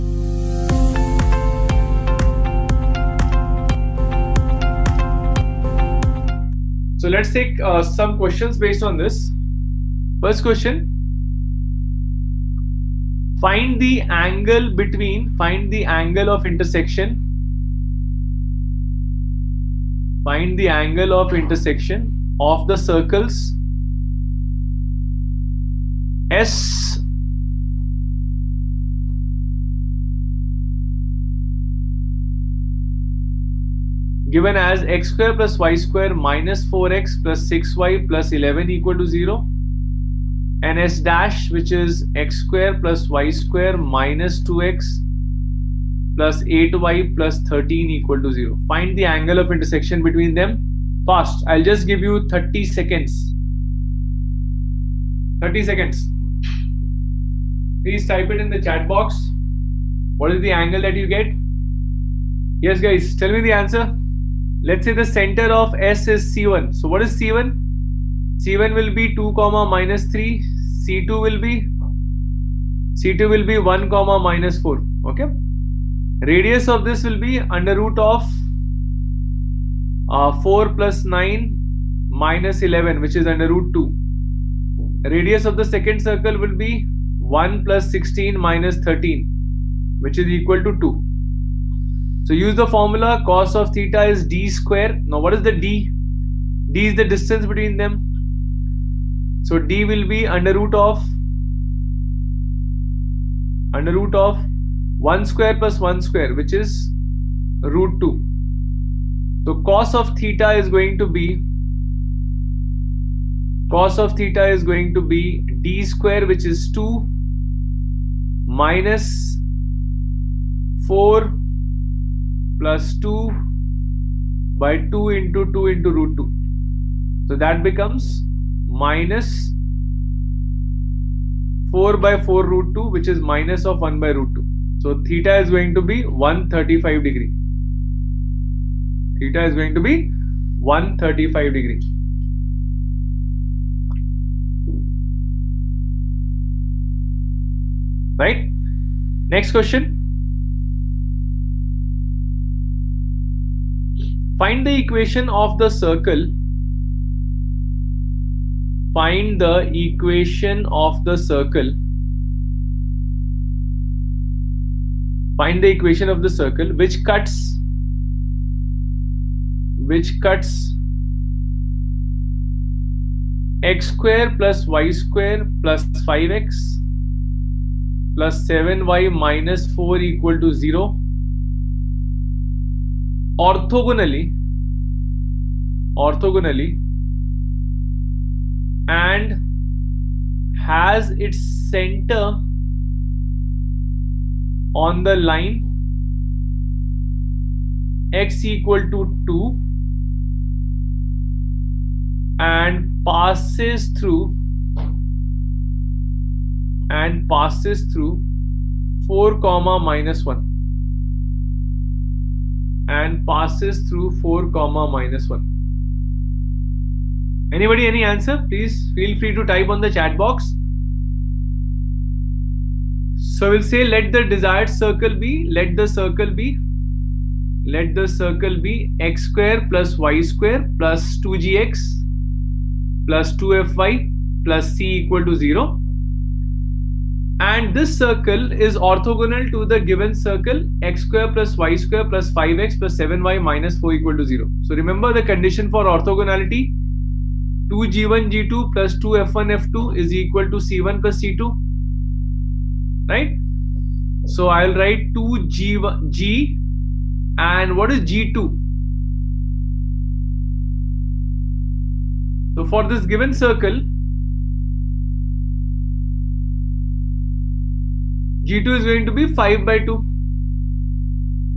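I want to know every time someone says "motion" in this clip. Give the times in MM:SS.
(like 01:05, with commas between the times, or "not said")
not said.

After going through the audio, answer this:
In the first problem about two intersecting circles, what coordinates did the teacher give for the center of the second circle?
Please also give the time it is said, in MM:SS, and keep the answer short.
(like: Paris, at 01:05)
(1, -4), at 01:13.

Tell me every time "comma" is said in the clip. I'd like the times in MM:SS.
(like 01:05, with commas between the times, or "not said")
01:09, 01:13, 03:29, 03:34.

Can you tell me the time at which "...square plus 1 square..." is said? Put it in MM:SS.
01:45.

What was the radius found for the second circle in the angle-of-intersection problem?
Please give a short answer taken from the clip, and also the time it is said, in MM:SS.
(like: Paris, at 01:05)
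2, at 01:29.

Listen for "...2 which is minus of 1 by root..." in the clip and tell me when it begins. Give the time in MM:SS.
02:12.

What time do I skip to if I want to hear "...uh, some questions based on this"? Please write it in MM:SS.
00:07.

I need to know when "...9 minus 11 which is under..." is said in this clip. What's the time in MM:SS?
01:21.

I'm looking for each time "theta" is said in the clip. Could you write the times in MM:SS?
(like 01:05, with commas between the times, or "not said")
01:33, 01:50, 01:54, 02:15, 02:19.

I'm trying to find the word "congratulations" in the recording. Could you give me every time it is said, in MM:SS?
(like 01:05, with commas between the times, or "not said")
not said.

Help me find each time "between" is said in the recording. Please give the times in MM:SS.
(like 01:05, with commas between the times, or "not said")
00:14, 00:50, 01:37.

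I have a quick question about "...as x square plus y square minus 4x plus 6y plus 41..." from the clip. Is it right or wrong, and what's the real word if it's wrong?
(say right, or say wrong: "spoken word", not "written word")
wrong: "11", not "41".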